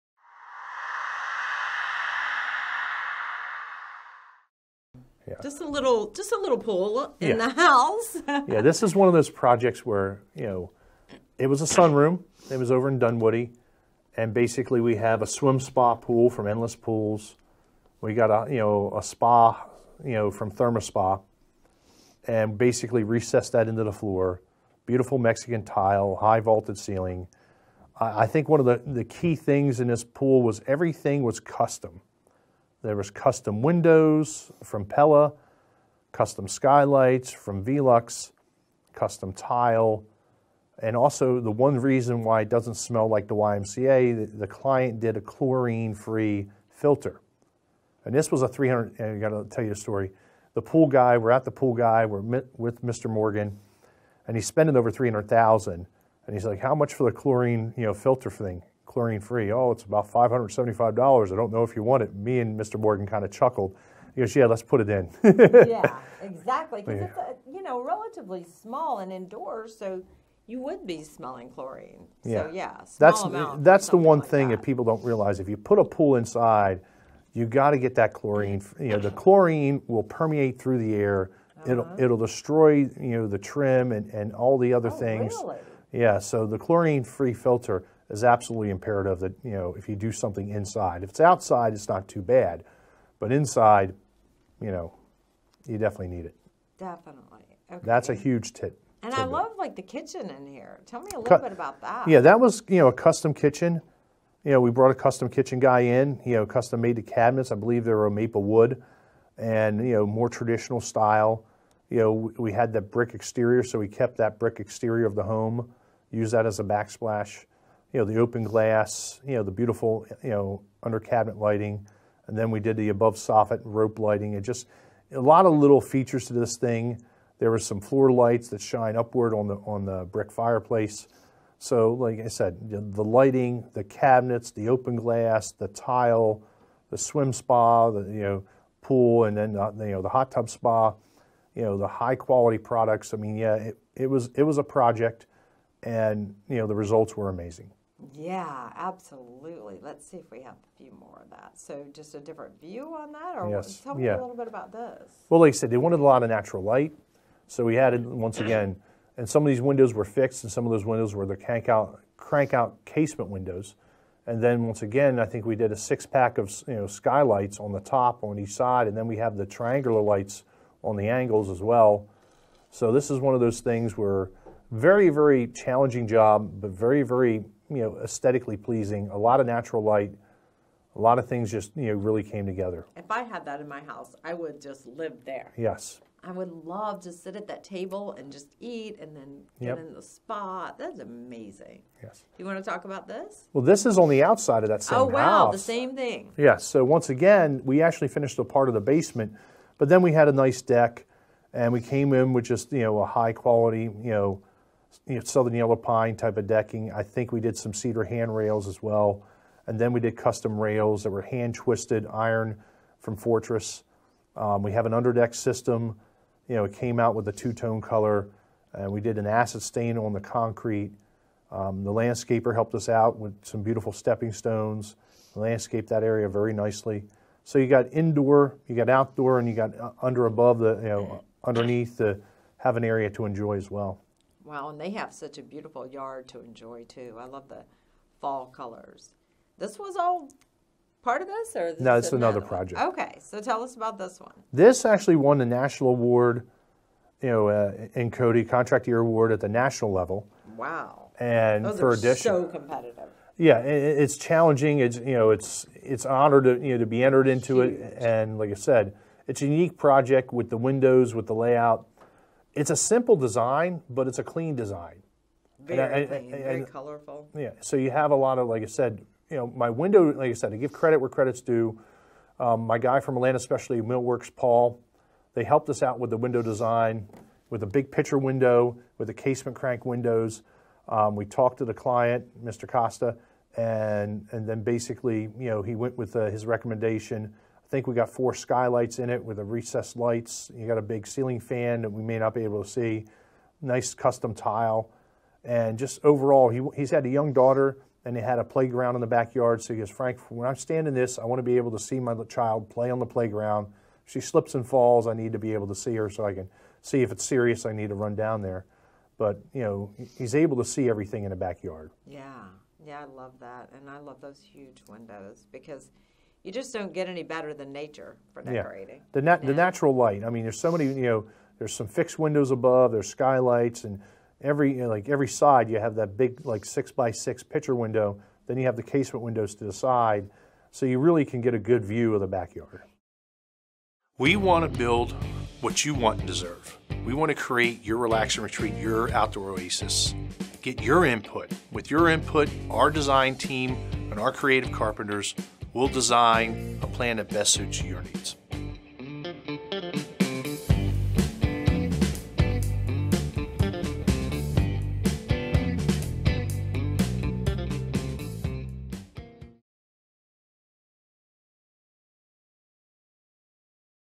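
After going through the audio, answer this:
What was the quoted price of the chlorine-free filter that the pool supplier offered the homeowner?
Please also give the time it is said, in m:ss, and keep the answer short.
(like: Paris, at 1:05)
$575, at 1:00.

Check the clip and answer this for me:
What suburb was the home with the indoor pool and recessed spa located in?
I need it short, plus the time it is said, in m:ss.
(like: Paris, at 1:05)
Dunwoody, at 0:12.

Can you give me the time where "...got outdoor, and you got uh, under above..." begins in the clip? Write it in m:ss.
3:48.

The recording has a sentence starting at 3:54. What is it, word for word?
Wow, and they have such a beautiful yard to enjoy too.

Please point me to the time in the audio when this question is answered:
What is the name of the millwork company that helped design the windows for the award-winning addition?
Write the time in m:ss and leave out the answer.
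4:33.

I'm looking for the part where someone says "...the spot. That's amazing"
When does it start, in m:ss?
3:09.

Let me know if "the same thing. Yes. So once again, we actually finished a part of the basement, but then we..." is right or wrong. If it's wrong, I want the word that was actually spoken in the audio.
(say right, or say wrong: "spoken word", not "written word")
right.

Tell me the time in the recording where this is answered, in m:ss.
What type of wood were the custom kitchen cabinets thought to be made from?
1:48.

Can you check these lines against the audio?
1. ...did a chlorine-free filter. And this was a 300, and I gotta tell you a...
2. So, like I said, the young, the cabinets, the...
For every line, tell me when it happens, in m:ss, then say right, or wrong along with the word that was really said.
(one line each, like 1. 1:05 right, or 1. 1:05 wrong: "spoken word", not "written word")
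1. 0:44 right
2. 2:11 wrong: "lighting", not "young".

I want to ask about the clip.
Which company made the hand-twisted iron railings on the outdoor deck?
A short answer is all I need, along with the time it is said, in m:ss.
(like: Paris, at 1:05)
Fortress, at 3:33.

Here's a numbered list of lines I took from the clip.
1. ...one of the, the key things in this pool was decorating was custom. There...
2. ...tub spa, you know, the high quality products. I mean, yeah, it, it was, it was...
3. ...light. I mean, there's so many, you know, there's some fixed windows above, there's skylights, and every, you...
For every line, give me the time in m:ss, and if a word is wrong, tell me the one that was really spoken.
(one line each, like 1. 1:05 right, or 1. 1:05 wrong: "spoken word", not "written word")
1. 0:28 wrong: "everything", not "decorating"
2. 2:20 right
3. 5:19 right.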